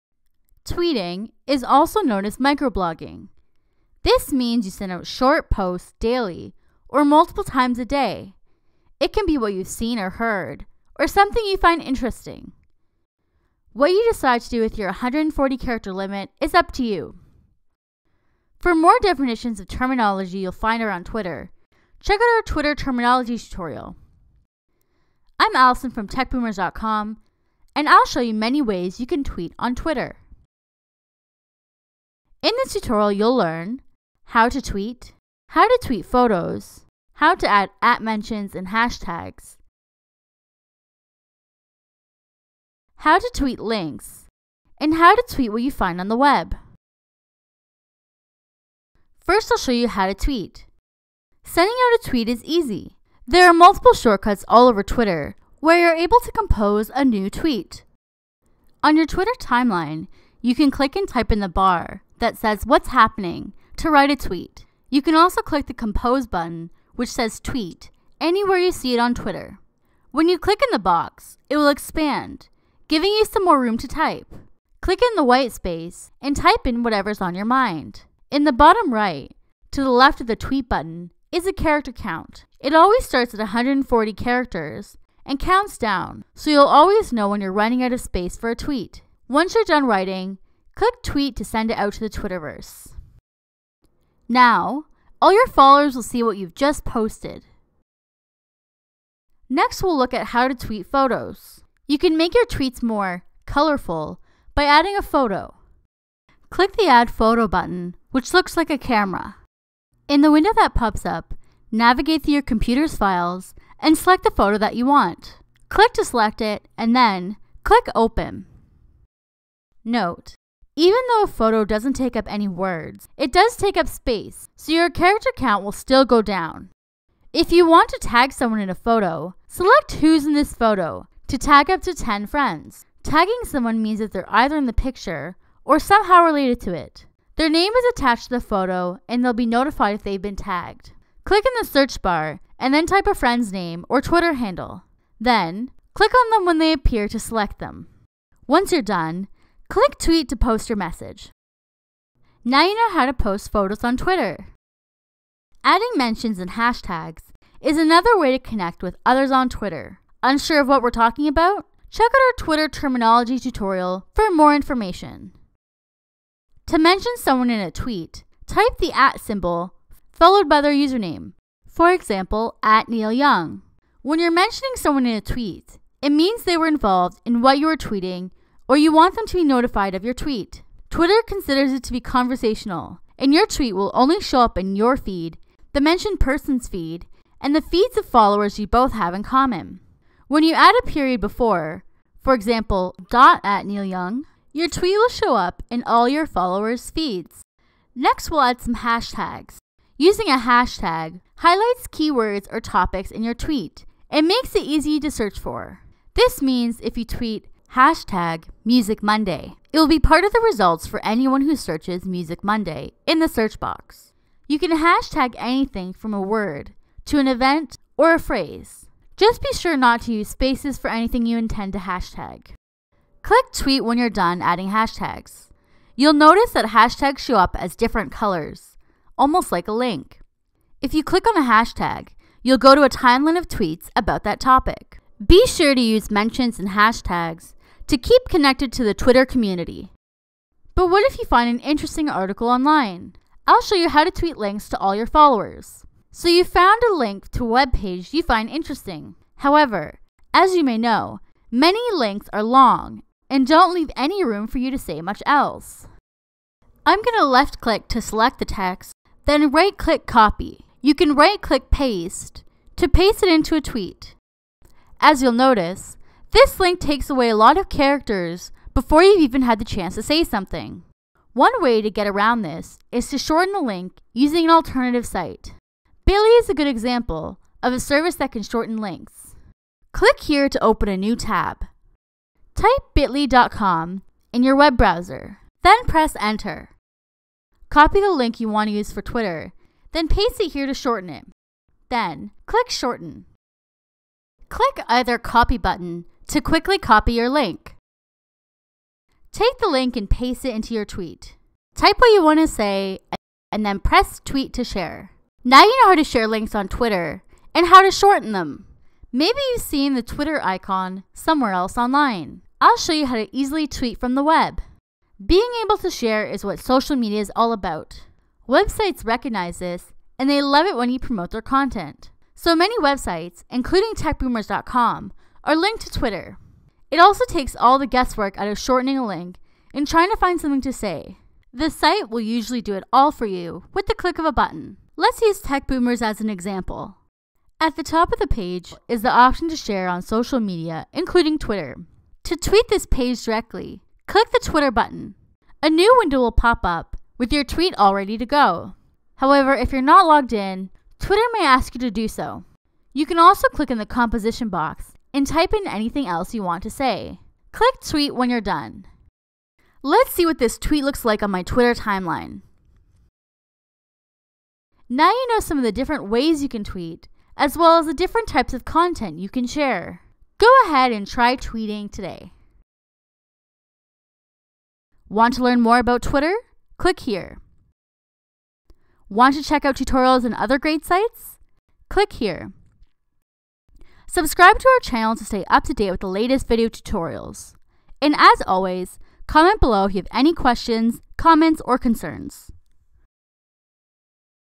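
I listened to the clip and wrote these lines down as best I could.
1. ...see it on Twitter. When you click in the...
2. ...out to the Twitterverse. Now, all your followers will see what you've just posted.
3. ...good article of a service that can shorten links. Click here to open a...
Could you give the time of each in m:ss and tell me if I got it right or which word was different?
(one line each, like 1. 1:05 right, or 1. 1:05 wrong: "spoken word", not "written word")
1. 1:08 right
2. 1:31 right
3. 4:36 wrong: "example", not "article".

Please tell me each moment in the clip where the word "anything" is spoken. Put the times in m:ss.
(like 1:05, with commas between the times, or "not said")
3:35, 3:40, 5:55.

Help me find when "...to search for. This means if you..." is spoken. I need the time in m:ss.
3:25.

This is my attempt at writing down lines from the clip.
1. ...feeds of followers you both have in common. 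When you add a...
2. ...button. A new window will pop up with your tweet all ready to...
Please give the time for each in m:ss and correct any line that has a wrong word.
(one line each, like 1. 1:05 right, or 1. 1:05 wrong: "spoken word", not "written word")
1. 3:07 right
2. 5:44 right.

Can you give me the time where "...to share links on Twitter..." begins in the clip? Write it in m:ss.
5:05.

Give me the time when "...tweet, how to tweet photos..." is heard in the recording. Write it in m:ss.
0:34.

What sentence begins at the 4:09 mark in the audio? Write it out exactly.
However, as you may know, many links are long and don't leave any room for you to say much else.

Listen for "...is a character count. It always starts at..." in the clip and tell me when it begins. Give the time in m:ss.
1:21.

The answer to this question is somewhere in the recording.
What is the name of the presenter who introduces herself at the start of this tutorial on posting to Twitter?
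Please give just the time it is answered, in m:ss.
0:25.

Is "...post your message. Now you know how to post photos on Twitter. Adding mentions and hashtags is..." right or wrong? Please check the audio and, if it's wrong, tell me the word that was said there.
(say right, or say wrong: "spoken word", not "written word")
right.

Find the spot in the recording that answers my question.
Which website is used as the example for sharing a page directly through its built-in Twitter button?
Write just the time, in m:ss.
5:35.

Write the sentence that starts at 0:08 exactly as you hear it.
It can be what you've seen or heard, or something you find interesting.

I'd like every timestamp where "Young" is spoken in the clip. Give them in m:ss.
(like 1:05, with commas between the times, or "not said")
2:53, 3:13.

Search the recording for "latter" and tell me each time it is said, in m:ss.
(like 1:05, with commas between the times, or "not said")
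not said.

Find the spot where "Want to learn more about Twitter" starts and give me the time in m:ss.
6:15.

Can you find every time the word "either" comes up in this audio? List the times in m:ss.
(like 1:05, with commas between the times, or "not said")
2:14, 4:54.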